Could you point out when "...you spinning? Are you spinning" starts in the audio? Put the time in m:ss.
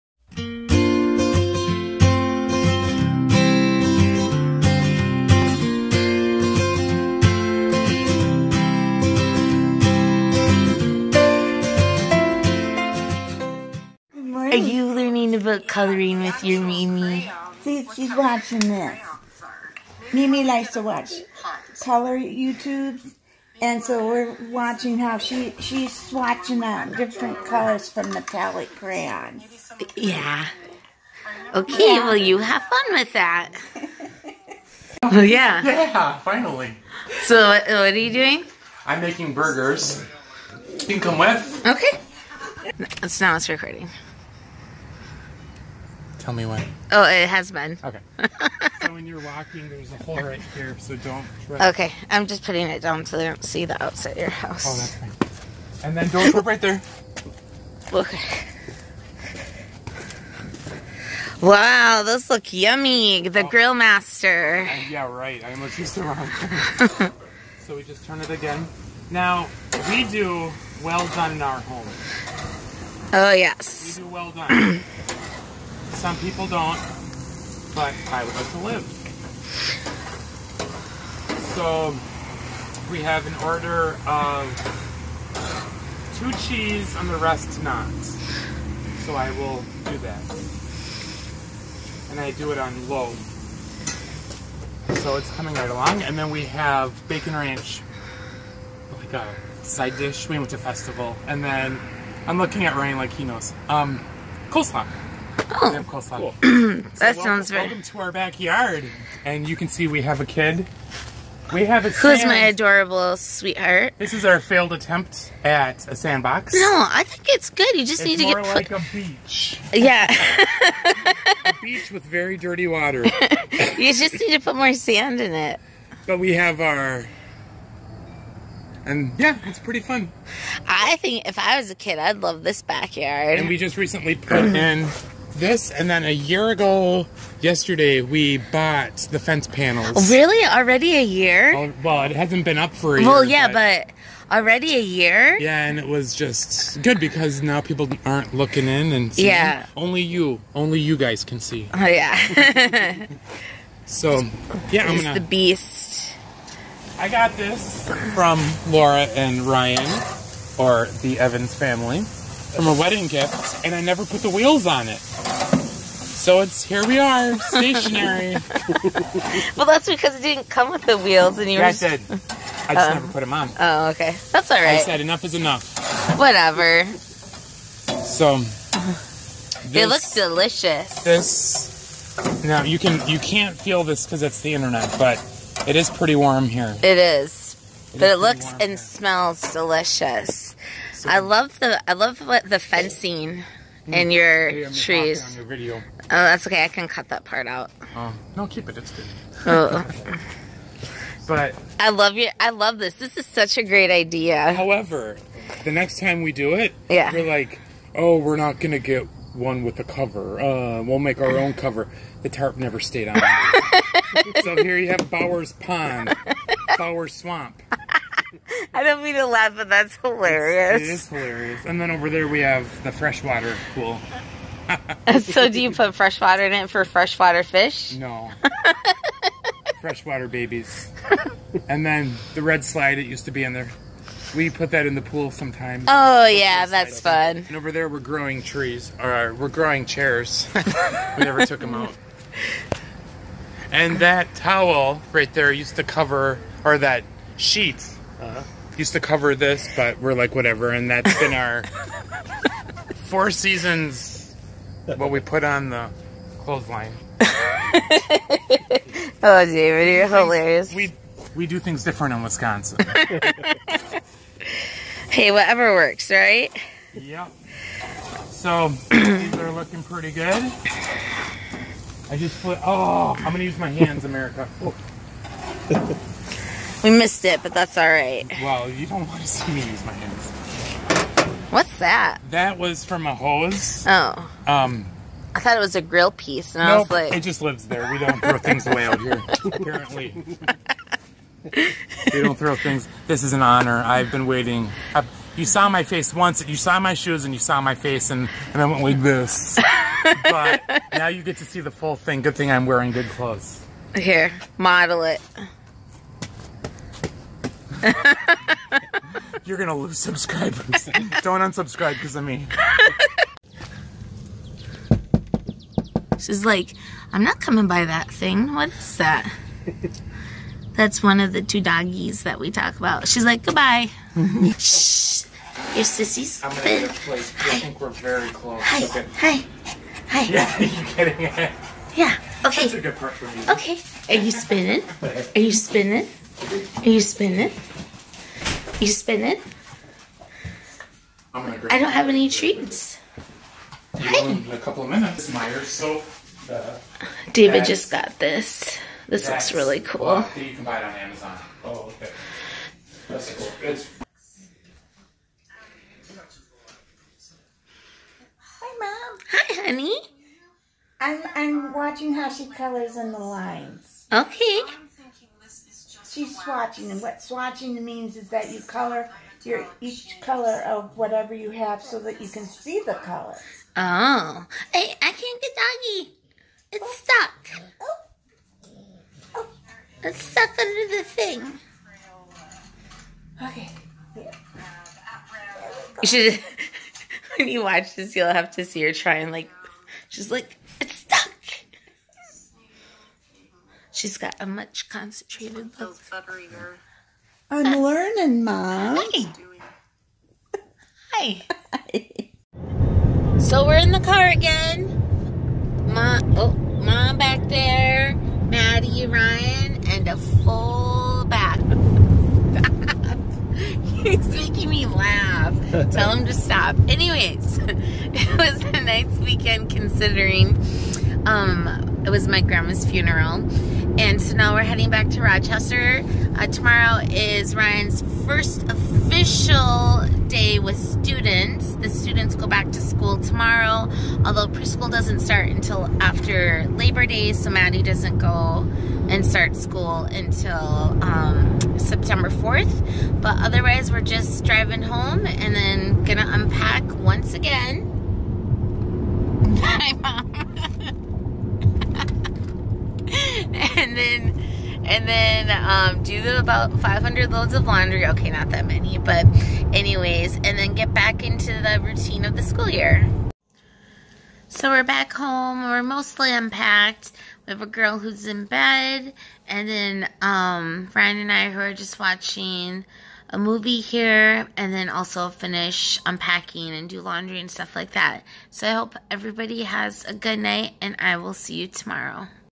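5:34.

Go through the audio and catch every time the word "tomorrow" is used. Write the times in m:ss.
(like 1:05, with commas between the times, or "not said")
7:06, 7:13, 8:01.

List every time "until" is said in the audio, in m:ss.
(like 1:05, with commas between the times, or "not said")
7:15, 7:20.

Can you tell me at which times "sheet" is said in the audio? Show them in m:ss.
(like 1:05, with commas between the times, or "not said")
4:07.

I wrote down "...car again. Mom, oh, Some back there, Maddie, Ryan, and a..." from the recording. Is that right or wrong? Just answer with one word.
wrong.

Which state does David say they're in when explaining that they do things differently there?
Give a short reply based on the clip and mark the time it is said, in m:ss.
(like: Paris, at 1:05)
Wisconsin, at 4:22.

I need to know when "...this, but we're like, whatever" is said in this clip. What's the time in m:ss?
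4:09.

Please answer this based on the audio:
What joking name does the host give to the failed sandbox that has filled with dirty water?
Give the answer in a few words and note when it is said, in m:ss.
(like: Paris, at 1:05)
Bower's Swamp, at 3:36.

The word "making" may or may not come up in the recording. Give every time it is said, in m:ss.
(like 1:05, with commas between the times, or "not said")
0:39, 6:54.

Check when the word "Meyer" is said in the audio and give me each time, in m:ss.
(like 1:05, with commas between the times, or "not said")
5:45.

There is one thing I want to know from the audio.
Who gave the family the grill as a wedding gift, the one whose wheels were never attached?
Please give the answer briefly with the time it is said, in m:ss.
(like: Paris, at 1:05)
Laura and Ryan, at 2:38.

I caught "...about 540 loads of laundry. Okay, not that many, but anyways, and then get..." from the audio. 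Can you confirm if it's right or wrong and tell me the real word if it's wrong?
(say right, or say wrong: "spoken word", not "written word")
wrong: "500", not "540".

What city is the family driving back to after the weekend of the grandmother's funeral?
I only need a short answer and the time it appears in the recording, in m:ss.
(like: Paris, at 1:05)
Rochester, at 7:05.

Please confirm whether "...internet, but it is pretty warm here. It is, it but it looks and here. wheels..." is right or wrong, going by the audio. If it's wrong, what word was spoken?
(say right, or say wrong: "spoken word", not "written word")
wrong: "smells", not "wheels".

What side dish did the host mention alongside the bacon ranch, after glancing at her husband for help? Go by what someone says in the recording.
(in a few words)
Coleslaw.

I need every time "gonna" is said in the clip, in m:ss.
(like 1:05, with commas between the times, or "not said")
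2:35, 3:28, 5:09, 5:26, 7:26.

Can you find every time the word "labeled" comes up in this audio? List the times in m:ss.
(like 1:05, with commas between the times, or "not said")
not said.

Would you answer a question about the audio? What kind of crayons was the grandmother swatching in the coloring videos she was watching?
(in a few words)
Metallic crayons.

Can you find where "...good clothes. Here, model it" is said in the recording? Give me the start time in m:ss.
5:02.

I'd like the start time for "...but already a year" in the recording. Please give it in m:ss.
2:24.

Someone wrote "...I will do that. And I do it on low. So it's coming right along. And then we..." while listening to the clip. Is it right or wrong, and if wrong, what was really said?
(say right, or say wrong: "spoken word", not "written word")
right.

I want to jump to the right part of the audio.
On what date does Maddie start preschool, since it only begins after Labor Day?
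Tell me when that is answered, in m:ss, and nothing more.
7:21.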